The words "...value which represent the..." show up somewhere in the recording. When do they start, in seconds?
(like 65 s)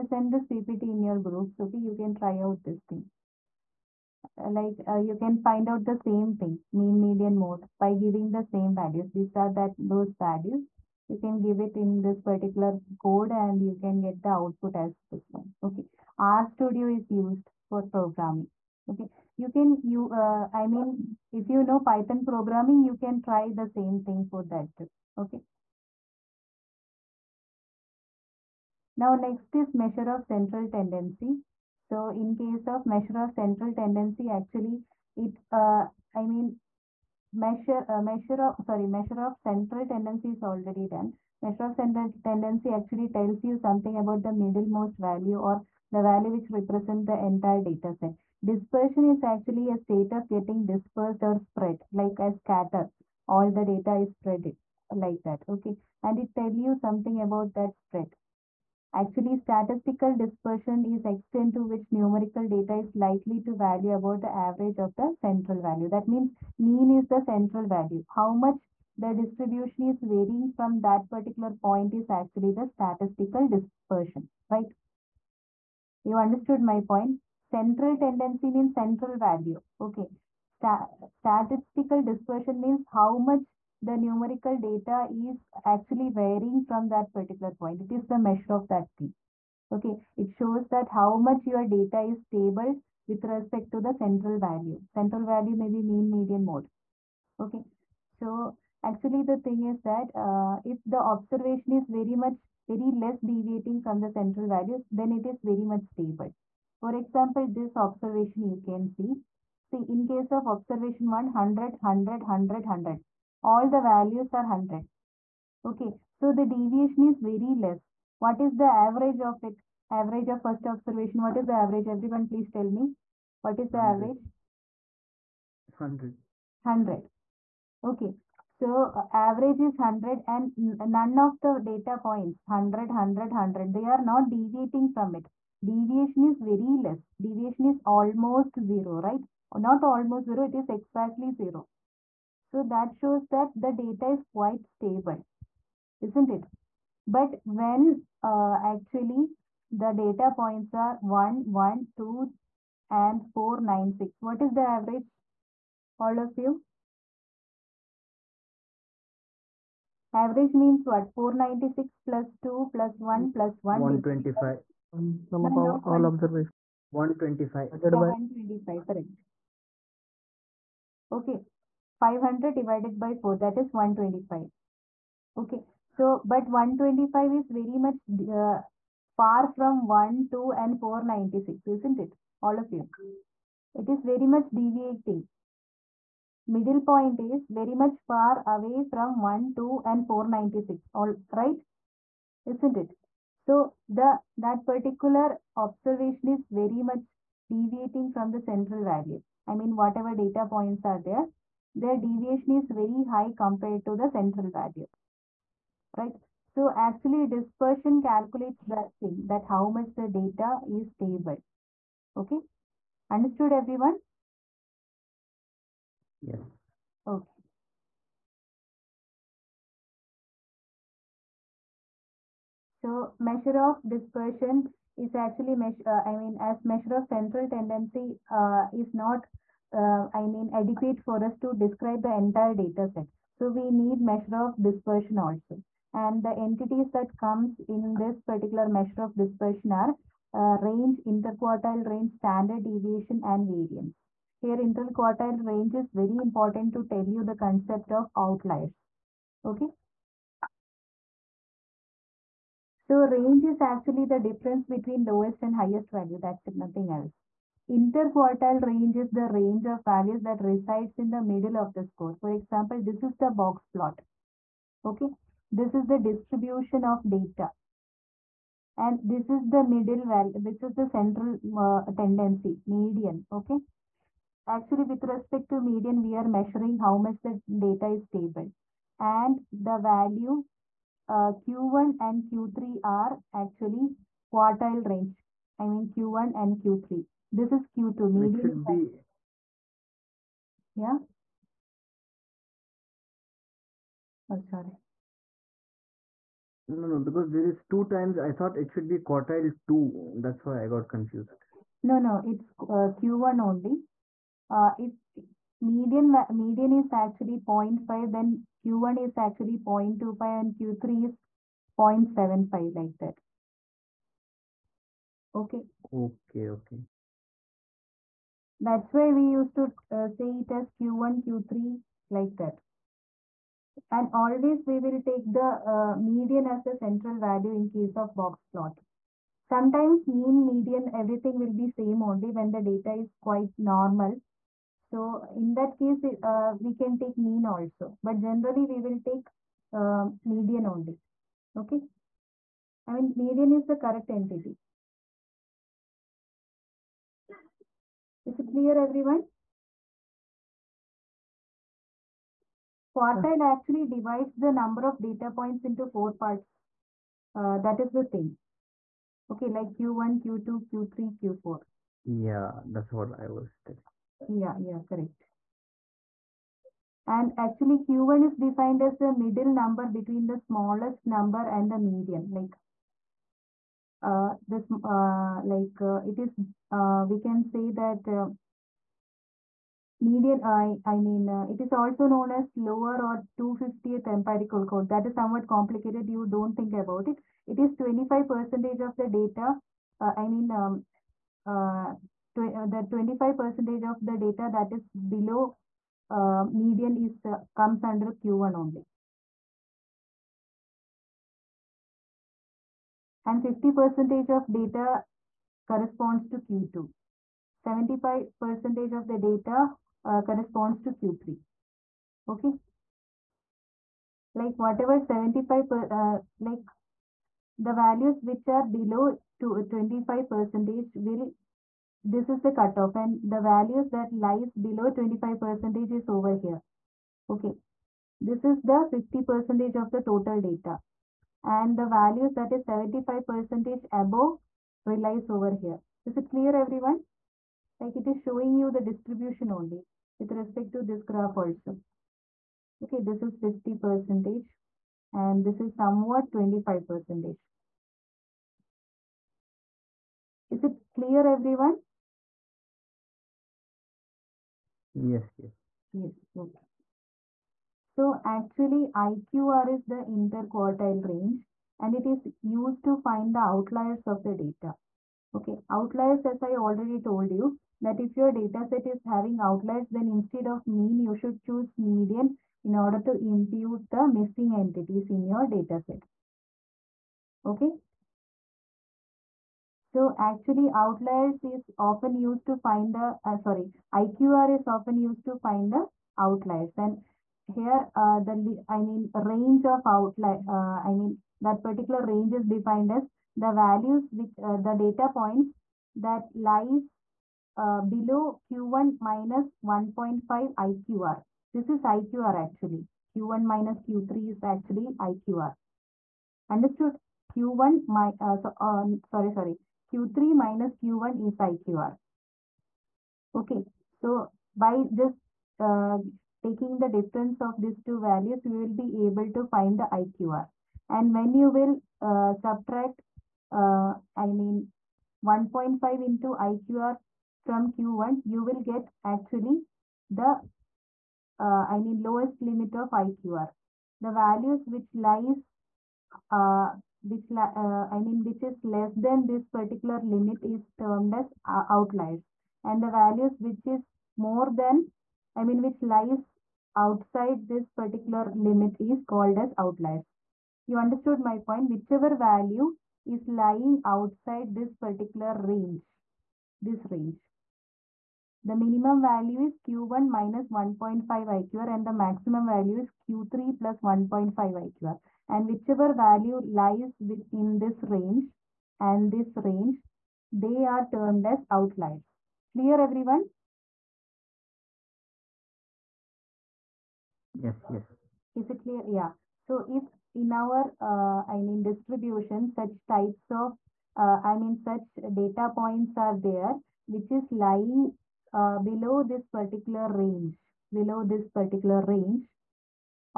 46 s.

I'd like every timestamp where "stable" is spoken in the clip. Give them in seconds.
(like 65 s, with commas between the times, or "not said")
92 s, 105 s, 144 s, 210 s, 278 s.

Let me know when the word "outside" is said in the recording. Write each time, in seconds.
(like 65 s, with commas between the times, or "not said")
546 s, 553 s.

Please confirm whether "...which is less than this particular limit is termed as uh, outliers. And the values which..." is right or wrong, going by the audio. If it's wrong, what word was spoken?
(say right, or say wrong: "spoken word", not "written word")
right.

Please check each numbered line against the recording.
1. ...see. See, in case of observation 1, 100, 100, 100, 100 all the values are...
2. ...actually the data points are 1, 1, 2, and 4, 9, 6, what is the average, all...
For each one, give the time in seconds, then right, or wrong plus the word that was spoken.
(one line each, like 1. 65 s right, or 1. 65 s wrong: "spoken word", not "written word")
1. 108 s right
2. 148 s right.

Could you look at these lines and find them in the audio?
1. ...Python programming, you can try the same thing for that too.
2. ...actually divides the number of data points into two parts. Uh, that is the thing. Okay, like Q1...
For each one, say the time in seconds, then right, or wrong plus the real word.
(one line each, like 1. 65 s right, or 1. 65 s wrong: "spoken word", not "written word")
1. 21 s right
2. 353 s wrong: "four", not "two".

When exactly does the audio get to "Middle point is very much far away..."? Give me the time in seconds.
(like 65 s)
186 s.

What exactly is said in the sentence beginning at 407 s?
75 percentage of the data uh, corresponds to Q3.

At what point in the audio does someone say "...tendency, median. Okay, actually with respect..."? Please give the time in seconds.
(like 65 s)
271 s.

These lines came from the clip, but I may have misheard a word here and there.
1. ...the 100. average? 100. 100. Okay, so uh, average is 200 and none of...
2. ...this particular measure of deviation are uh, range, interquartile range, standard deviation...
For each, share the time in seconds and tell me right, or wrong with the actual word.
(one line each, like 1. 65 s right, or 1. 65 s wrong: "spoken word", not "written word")
1. 123 s wrong: "100", not "200"
2. 237 s wrong: "dispersion", not "deviation".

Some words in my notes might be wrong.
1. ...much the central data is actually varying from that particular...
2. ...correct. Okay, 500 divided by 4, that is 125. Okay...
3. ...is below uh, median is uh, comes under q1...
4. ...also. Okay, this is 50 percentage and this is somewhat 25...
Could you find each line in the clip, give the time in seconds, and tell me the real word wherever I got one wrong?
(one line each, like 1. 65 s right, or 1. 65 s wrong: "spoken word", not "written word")
1. 83 s wrong: "numerical", not "central"
2. 168 s right
3. 394 s right
4. 441 s right.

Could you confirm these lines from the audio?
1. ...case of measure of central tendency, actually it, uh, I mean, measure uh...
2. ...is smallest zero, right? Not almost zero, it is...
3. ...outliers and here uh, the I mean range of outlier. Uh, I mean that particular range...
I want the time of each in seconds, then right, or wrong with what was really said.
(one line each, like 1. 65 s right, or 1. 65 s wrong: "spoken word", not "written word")
1. 32 s right
2. 137 s wrong: "almost", not "smallest"
3. 486 s right.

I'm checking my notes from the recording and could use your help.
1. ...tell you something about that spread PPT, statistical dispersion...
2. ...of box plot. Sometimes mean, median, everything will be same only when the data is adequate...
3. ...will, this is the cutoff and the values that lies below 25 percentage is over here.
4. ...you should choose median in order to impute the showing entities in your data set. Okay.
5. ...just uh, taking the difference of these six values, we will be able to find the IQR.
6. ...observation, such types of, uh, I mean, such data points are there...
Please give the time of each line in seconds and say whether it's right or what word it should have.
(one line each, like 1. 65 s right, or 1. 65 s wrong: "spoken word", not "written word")
1. 56 s wrong: "Actually", not "PPT"
2. 327 s wrong: "quite", not "adequate"
3. 420 s right
4. 470 s wrong: "missing", not "showing"
5. 514 s wrong: "two", not "six"
6. 581 s wrong: "distribution", not "observation".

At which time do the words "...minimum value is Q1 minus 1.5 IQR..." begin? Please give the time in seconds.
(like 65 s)
558 s.